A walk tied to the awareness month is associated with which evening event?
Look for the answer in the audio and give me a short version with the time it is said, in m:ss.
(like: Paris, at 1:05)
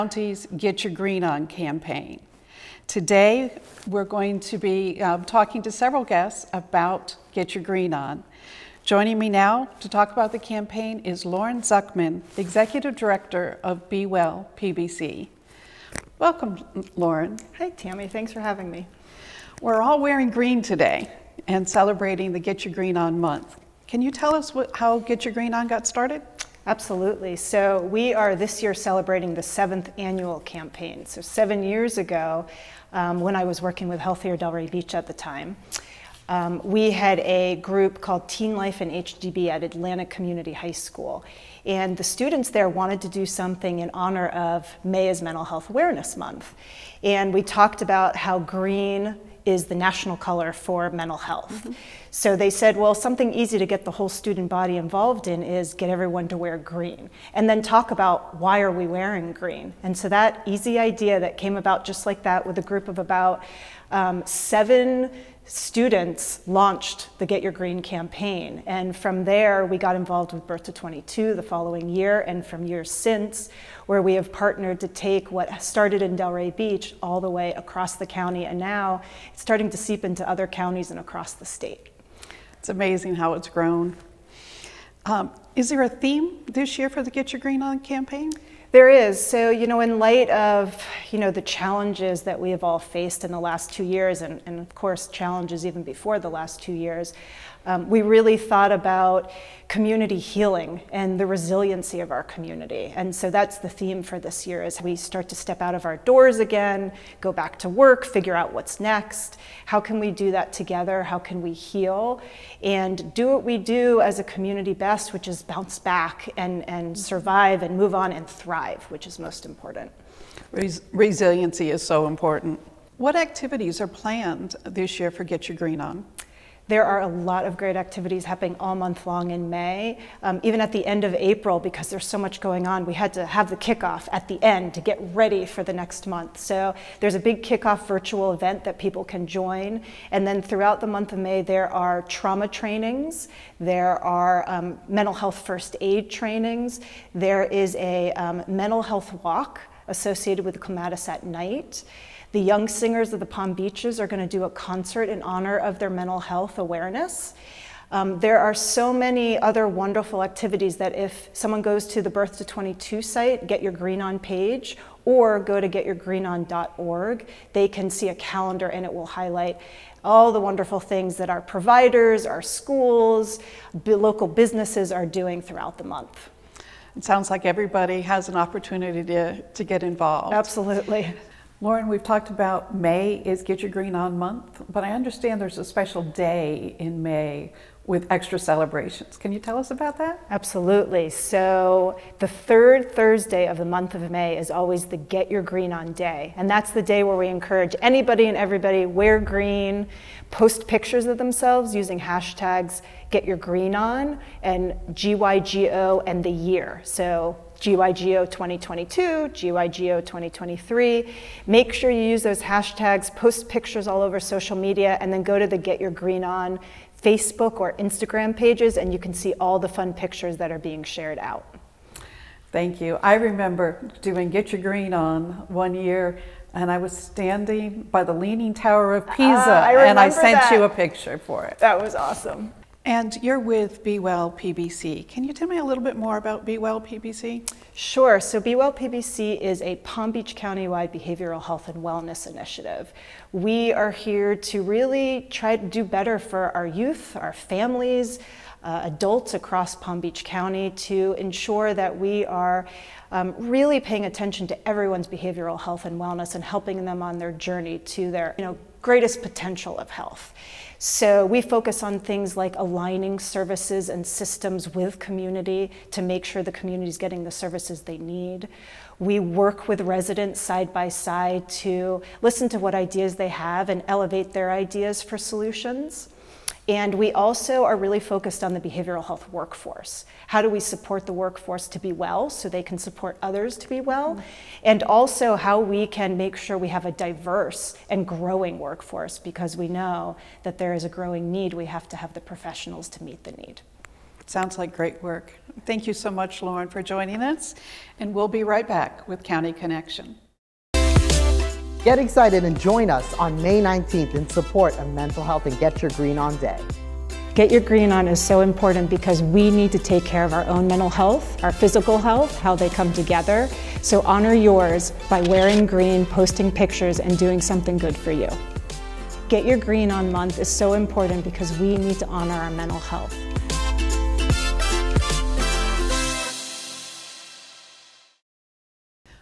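Clematis at night, at 2:30.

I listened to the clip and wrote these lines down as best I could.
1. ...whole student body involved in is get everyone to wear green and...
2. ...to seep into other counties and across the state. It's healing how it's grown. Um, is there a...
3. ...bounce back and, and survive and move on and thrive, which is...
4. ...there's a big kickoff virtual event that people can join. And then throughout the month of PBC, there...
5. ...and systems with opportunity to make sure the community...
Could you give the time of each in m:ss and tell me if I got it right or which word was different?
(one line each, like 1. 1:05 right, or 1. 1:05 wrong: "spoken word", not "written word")
1. 0:53 right
2. 1:19 wrong: "amazing", not "healing"
3. 1:55 right
4. 2:17 wrong: "May", not "PBC"
5. 4:23 wrong: "community", not "opportunity".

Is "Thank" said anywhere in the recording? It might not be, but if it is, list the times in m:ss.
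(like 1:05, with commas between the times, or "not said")
0:18, 3:42, 4:55.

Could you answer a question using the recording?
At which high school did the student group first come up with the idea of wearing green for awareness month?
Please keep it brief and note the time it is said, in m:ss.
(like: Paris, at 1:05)
Atlantic Community High School, at 0:39.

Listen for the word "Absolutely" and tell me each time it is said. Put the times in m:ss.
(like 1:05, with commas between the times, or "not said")
0:26, 3:00, 3:10.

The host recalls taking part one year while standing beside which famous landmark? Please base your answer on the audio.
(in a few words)
Leaning Tower of Pisa.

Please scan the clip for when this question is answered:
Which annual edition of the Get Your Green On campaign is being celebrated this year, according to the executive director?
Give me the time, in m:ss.
0:29.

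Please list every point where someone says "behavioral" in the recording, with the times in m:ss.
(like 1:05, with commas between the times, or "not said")
4:00, 4:15, 4:38.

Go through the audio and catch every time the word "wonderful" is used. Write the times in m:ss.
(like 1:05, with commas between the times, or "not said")
2:39, 2:50.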